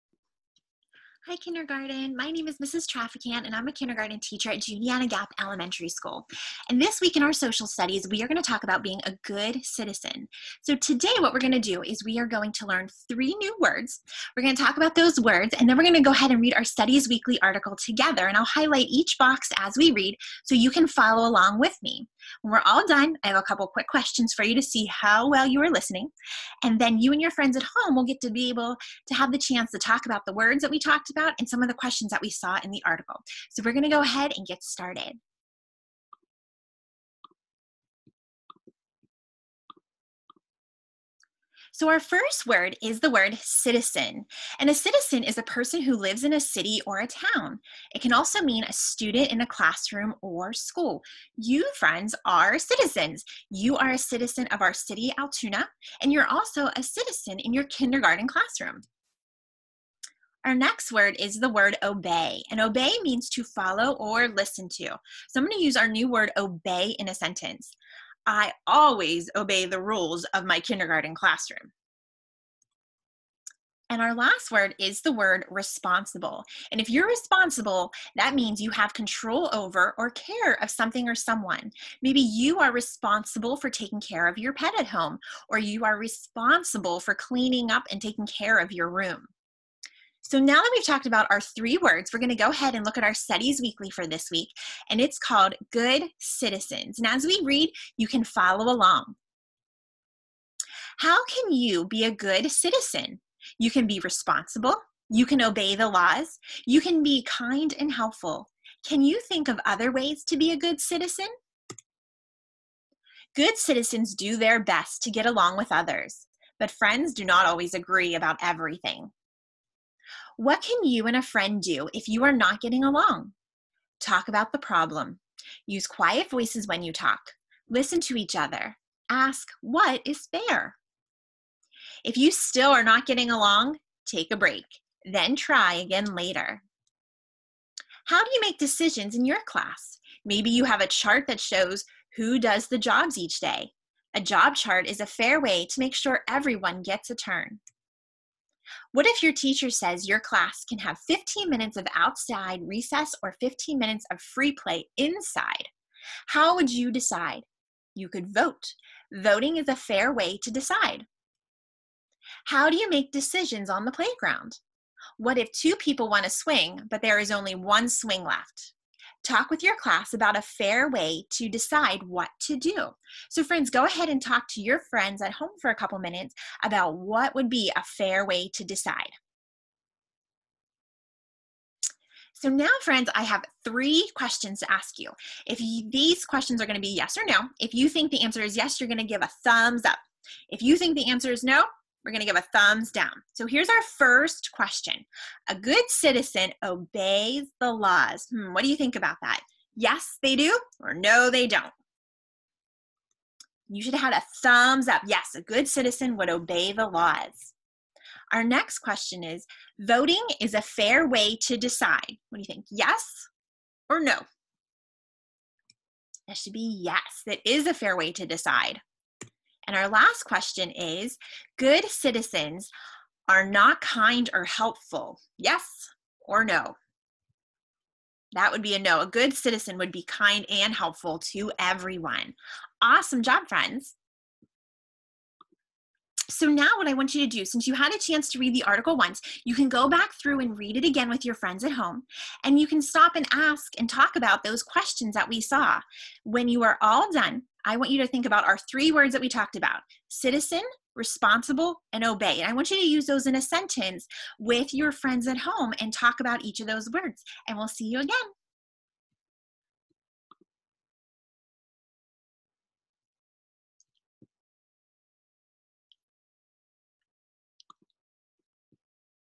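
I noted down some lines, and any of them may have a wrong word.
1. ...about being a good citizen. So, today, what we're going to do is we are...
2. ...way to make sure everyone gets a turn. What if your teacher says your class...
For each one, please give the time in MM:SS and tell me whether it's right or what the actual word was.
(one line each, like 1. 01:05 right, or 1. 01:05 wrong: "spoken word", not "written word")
1. 00:08 right
2. 02:25 right.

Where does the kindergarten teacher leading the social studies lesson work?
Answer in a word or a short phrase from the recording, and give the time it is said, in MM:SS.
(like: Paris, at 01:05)
Juniata Gap Elementary School, at 00:04.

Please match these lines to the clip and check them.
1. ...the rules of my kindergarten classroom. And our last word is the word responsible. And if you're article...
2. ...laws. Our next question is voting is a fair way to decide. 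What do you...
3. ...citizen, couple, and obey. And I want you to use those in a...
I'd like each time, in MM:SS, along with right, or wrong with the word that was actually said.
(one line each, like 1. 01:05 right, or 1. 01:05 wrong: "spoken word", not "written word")
1. 01:09 wrong: "responsible", not "article"
2. 03:26 right
3. 04:10 wrong: "responsible", not "couple".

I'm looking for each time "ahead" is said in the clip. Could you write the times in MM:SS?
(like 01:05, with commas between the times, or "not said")
00:16, 00:34, 01:32, 02:53.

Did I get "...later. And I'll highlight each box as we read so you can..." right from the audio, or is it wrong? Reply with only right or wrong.
wrong.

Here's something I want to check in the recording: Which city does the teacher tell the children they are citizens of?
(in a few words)
Altoona.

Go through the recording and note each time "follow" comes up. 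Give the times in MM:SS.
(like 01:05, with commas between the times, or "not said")
00:20, 01:03, 01:38.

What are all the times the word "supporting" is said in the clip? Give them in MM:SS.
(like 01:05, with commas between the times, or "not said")
not said.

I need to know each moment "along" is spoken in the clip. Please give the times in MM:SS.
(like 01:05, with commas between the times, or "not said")
00:21, 01:38, 01:55, 02:02, 02:13.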